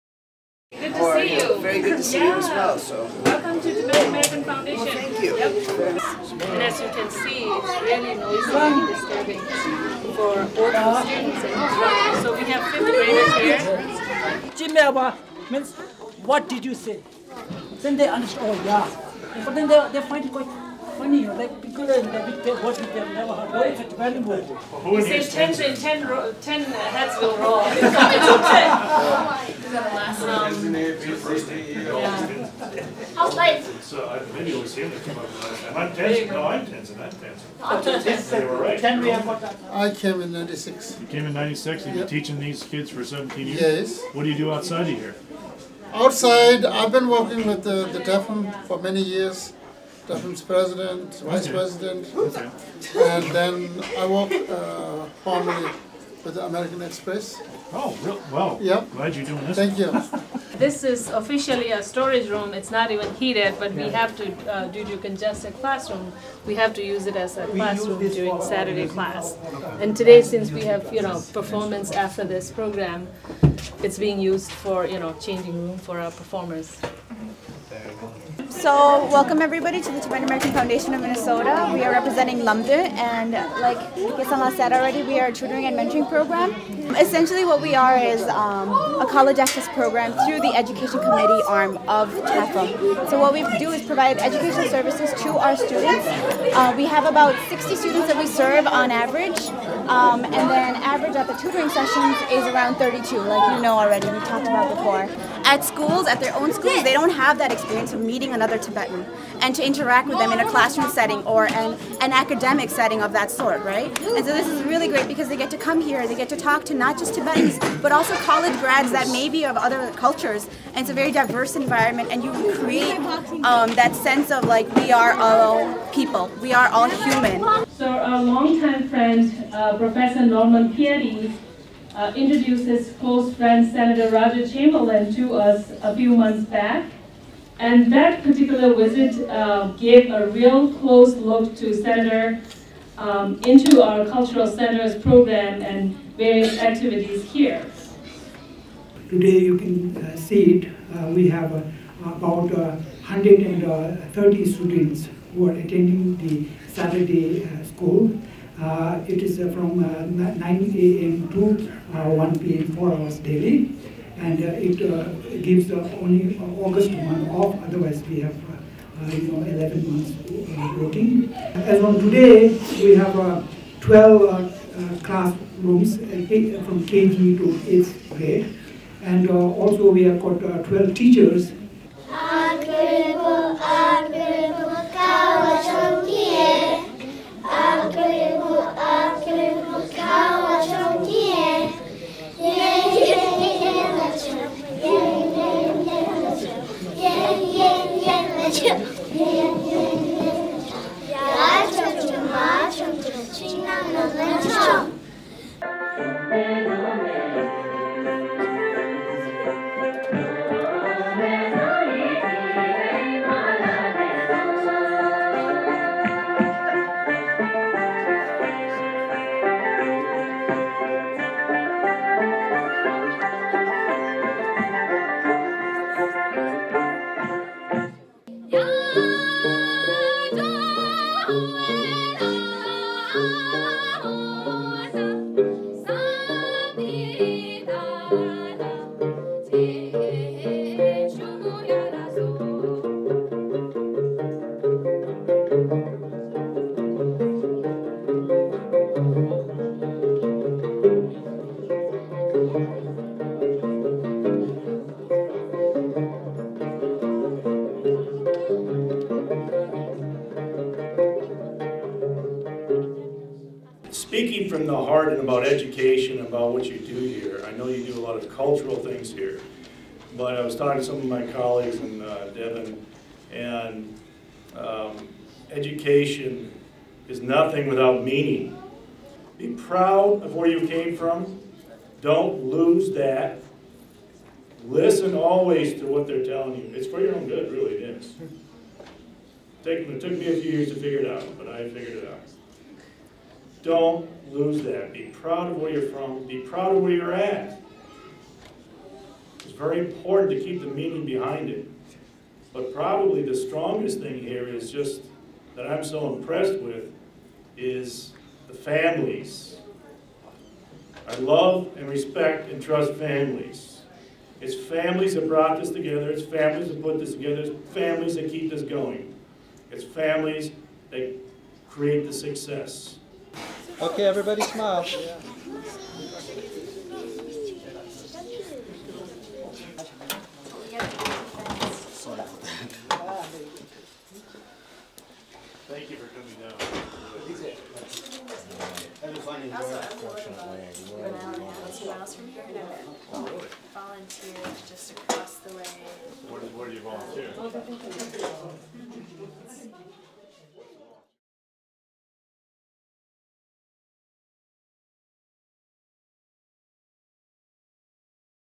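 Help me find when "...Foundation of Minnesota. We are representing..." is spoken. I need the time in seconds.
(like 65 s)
80 s.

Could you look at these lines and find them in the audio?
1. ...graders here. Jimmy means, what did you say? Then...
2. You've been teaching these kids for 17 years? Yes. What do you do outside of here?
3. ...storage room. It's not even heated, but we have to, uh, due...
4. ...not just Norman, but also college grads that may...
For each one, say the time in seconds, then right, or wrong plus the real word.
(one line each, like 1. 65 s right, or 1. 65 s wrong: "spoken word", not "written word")
1. 12 s right
2. 41 s right
3. 61 s right
4. 116 s wrong: "Tibetans", not "Norman".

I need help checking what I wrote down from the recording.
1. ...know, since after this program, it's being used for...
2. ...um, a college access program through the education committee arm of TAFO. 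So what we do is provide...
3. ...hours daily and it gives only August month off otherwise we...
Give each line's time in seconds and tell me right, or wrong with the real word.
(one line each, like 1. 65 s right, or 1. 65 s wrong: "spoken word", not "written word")
1. 71 s wrong: "performance", not "since"
2. 88 s right
3. 162 s right.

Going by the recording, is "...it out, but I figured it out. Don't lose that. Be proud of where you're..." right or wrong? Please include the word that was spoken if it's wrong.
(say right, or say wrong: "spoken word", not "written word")
right.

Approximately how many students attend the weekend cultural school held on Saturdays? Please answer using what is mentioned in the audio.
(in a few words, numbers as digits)
130.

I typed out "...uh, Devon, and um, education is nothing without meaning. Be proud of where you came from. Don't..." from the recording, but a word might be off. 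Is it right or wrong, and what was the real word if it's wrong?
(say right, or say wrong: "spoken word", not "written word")
right.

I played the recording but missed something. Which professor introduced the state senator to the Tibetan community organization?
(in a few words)
Norman Peary.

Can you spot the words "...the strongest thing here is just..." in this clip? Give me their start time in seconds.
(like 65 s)
303 s.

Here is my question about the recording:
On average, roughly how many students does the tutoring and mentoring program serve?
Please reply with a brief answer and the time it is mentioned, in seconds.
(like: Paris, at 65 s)
60, at 97 s.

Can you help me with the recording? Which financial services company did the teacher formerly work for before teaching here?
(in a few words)
American Express.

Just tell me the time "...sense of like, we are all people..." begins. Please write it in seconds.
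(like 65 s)
123 s.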